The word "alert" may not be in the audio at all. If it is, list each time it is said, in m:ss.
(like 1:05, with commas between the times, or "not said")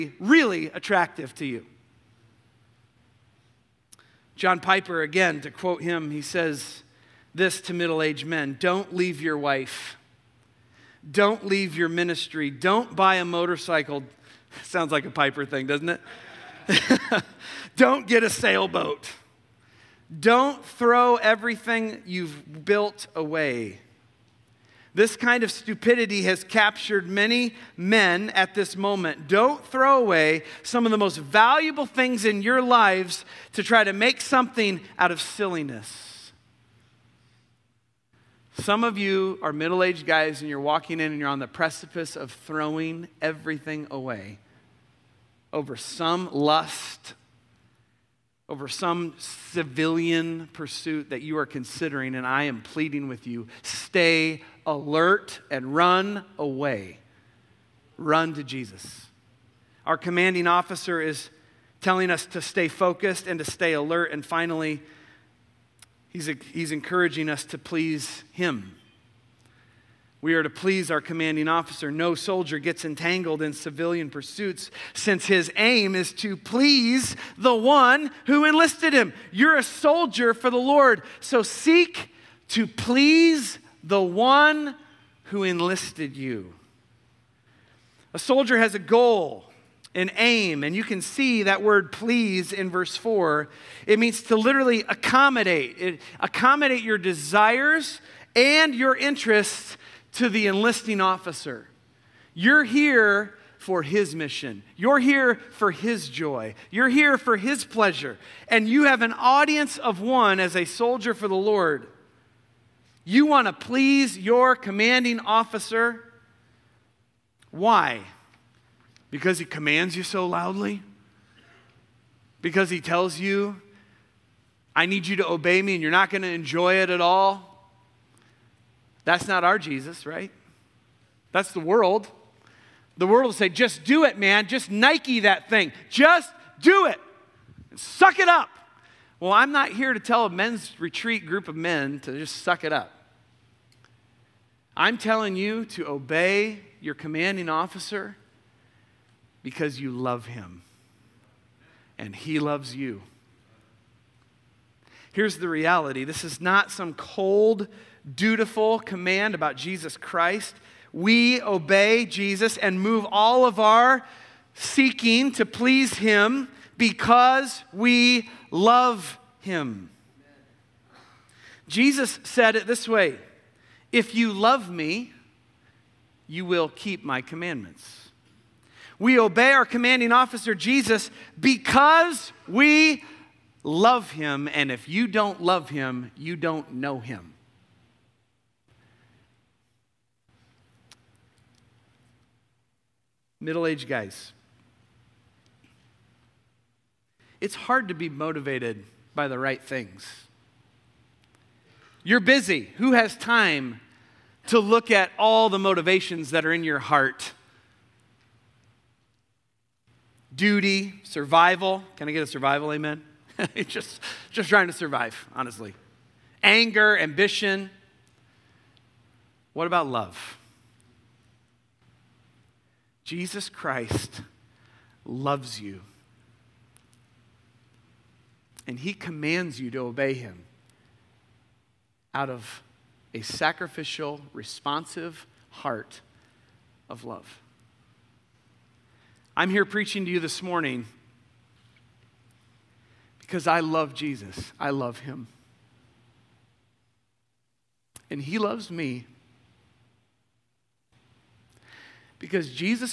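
0:54, 1:03.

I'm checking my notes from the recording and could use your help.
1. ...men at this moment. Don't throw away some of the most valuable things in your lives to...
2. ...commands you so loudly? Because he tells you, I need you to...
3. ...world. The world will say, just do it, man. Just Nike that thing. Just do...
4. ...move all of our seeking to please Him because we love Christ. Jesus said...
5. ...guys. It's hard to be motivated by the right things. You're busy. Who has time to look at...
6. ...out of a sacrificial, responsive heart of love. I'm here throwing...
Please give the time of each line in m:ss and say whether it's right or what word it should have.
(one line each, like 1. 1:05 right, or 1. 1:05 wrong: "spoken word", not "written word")
1. 0:27 right
2. 1:59 right
3. 2:11 right
4. 2:42 wrong: "Him", not "Christ"
5. 3:13 right
6. 3:52 wrong: "preaching", not "throwing".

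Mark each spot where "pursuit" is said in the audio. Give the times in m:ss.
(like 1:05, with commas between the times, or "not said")
0:50, 1:14.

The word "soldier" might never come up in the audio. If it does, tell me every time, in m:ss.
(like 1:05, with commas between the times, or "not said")
1:12, 1:19, 1:28, 1:50.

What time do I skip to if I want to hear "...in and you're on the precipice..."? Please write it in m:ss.
0:40.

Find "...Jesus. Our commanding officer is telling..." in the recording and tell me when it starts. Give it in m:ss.
0:58.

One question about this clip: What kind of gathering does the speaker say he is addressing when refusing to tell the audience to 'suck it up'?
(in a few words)
A men's retreat.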